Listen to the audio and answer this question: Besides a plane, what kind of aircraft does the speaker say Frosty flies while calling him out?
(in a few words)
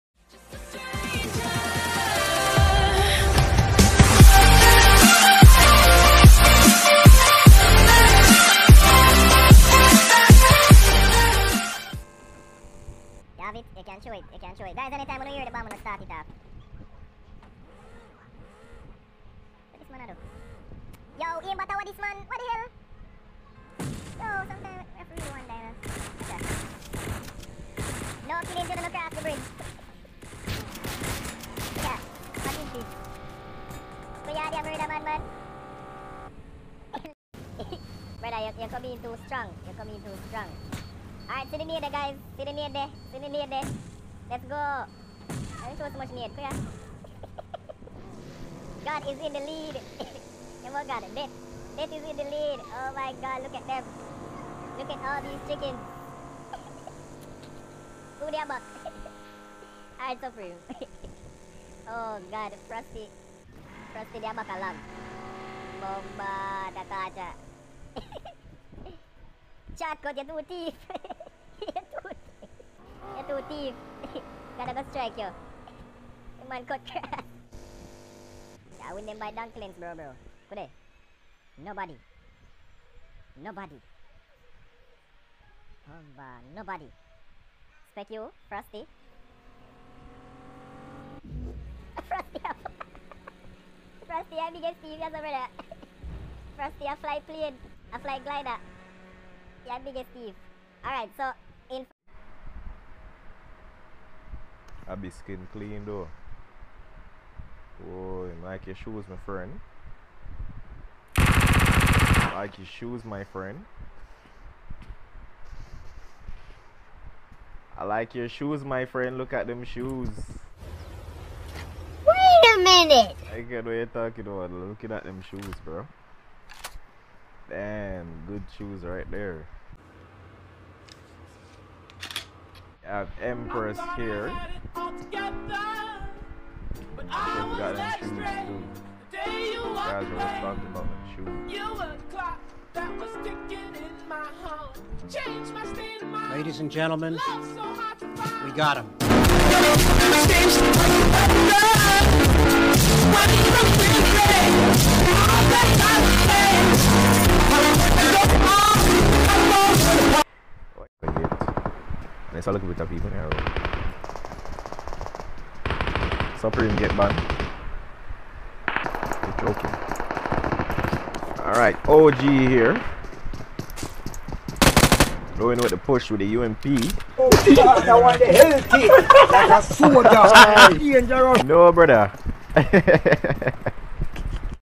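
glider.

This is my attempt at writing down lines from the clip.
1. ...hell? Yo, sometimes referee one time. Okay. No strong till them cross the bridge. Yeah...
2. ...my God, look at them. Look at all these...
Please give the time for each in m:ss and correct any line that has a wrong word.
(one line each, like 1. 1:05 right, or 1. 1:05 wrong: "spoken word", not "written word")
1. 0:22 wrong: "killing", not "strong"
2. 0:52 right.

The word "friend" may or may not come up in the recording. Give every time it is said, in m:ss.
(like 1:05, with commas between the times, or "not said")
1:49, 1:53, 1:58.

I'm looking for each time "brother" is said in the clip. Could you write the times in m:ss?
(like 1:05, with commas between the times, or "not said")
0:38, 3:01.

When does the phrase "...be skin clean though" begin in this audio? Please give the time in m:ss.
1:44.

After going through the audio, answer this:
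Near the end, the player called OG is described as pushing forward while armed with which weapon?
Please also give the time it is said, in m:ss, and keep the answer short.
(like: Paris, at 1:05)
UMP, at 2:56.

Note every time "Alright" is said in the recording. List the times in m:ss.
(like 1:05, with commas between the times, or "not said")
0:41, 1:00, 1:40, 2:51.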